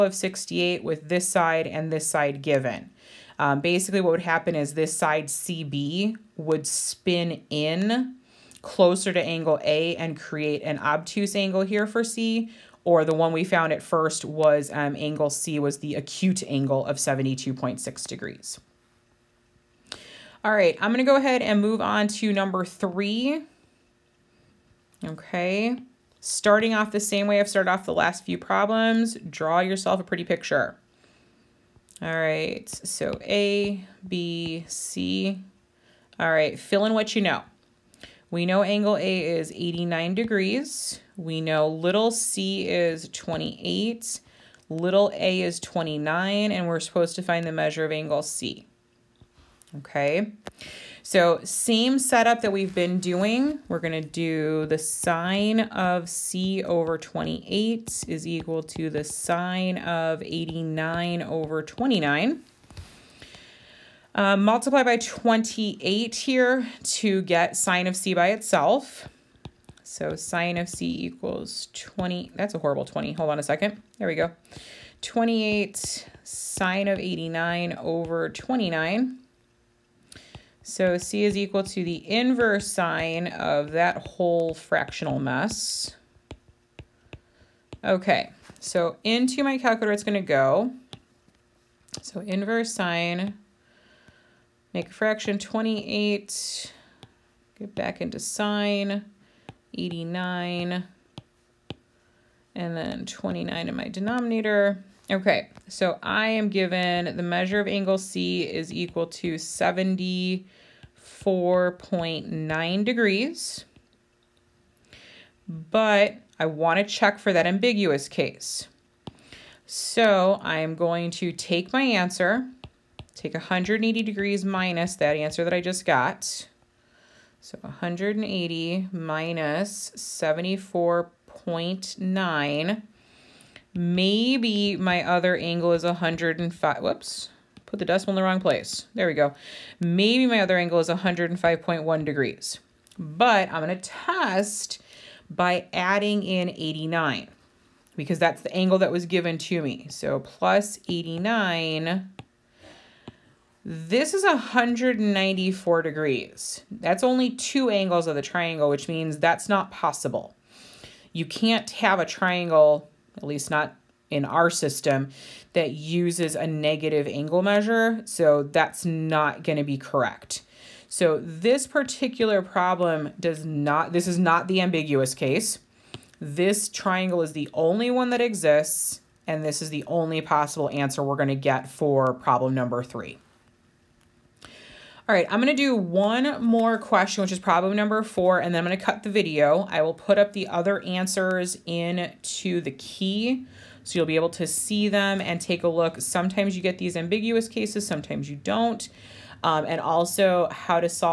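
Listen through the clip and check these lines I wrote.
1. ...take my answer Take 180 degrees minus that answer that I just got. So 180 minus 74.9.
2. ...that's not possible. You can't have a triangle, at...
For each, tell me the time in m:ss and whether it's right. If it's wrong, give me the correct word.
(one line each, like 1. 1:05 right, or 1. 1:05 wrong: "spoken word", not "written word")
1. 2:01 right
2. 2:39 right.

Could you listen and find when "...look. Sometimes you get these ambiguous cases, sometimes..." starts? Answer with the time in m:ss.
3:15.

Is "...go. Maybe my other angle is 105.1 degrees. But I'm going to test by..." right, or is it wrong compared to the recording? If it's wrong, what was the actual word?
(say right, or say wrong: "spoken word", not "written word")
right.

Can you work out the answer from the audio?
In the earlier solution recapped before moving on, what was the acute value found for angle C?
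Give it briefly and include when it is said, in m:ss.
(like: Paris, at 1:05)
72.6 degrees, at 0:16.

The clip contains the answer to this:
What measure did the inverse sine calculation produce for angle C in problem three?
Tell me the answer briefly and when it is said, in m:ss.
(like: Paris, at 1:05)
74.9 degrees, at 1:49.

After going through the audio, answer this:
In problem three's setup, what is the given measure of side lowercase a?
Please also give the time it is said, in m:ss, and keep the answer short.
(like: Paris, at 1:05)
29, at 0:44.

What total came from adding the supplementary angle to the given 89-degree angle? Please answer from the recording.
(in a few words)
194 degrees.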